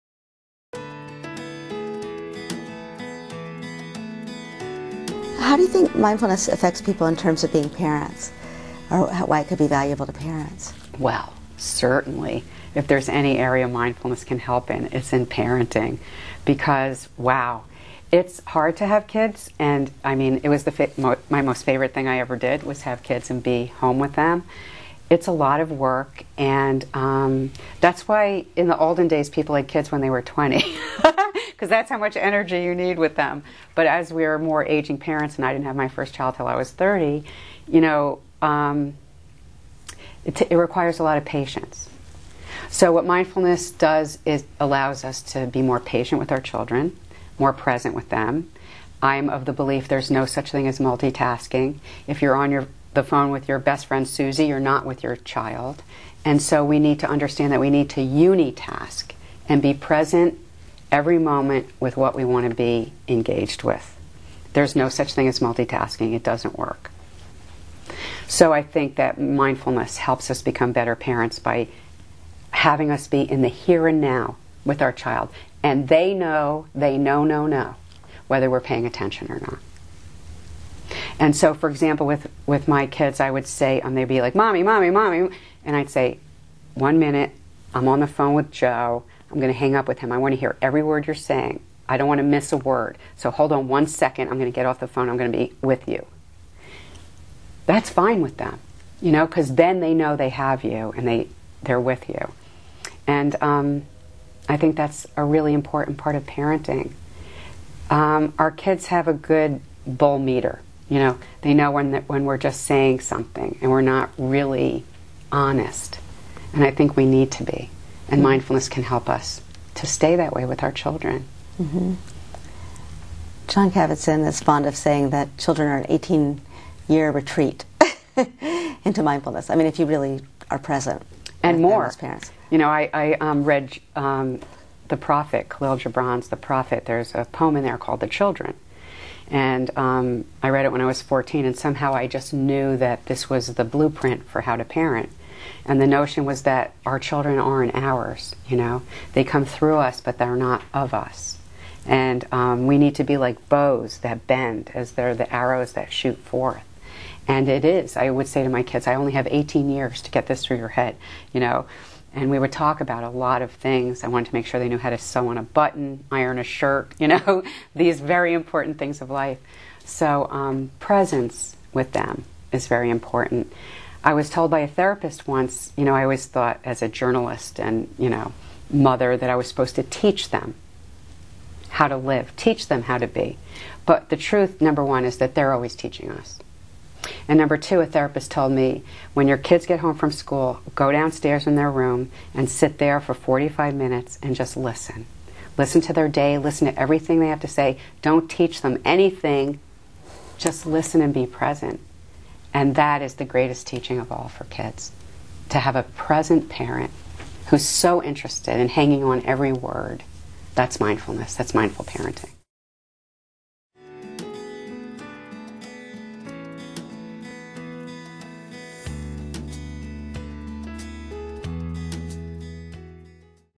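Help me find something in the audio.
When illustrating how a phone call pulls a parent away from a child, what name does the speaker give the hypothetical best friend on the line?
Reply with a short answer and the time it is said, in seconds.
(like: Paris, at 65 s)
Susie, at 54 s.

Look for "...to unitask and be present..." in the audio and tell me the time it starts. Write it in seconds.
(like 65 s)
57 s.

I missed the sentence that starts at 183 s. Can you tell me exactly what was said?
But the truth, number one, is that they're always teaching us.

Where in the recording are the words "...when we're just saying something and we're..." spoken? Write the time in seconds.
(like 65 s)
112 s.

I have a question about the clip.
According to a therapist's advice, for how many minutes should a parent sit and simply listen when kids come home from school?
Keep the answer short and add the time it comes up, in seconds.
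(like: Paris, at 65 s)
45 minutes, at 193 s.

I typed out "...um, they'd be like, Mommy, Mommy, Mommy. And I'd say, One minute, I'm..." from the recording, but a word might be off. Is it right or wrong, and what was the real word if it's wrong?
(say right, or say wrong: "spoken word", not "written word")
right.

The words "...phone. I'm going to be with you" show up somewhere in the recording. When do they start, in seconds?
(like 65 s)
94 s.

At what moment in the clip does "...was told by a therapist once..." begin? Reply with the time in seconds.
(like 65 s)
174 s.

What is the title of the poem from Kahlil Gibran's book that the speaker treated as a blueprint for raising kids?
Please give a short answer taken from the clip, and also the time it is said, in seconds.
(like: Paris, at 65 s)
The Children, at 138 s.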